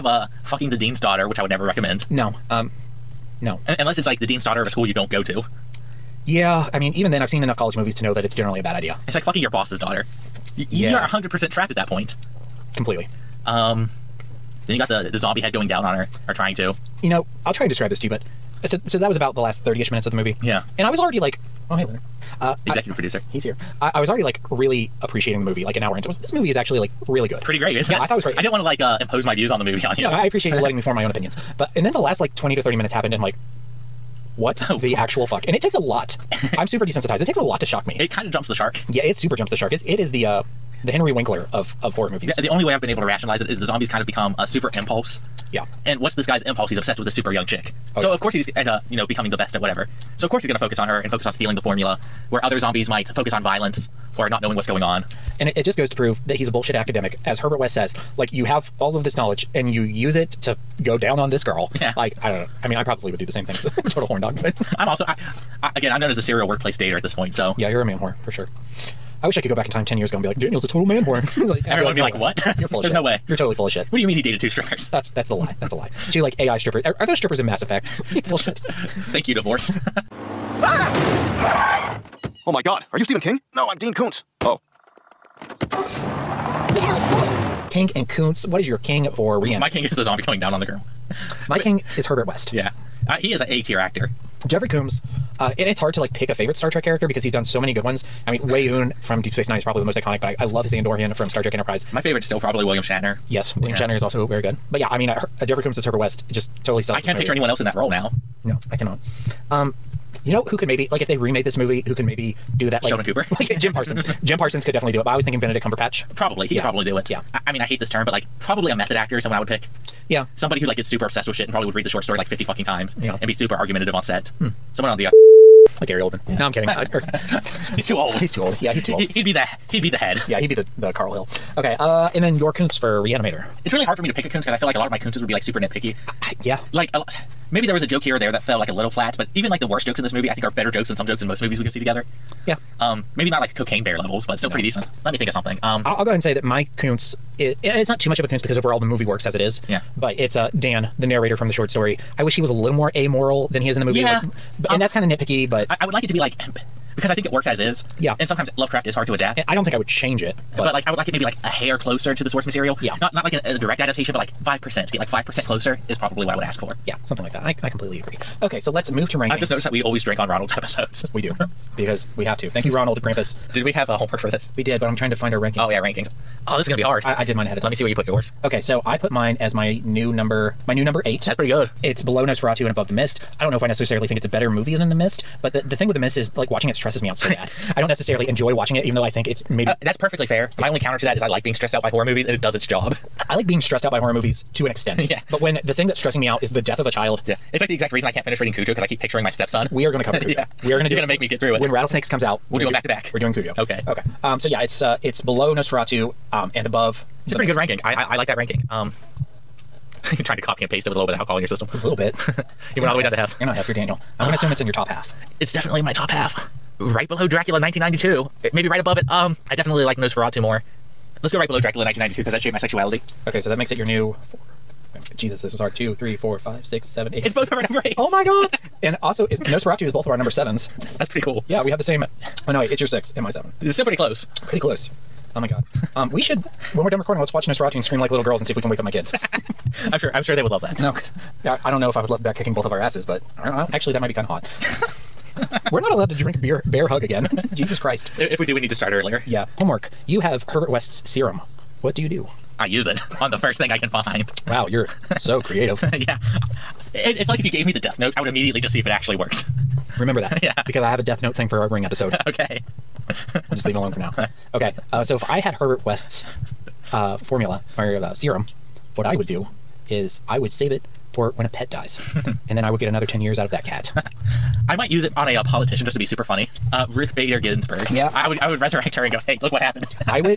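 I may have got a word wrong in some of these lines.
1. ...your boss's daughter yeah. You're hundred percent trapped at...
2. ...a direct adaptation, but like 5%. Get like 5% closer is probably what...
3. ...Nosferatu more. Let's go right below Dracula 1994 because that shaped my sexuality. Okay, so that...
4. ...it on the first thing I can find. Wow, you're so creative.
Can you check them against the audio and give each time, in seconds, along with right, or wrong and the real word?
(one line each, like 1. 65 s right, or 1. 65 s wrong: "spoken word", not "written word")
1. 9 s right
2. 163 s right
3. 219 s wrong: "1992", not "1994"
4. 252 s right.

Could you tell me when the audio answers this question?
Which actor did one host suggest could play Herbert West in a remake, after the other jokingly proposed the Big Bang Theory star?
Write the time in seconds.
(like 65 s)
115 s.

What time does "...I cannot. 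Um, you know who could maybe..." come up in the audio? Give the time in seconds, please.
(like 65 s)
108 s.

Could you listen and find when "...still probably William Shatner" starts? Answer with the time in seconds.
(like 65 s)
102 s.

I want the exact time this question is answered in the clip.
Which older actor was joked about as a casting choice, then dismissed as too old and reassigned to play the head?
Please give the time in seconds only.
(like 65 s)
125 s.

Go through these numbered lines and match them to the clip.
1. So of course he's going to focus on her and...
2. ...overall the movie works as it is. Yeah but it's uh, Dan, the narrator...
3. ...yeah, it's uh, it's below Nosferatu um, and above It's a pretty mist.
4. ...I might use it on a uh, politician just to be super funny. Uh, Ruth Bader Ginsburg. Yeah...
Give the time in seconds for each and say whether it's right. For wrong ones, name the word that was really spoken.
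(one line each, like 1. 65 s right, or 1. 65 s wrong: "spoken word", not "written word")
1. 50 s right
2. 148 s right
3. 204 s right
4. 274 s right.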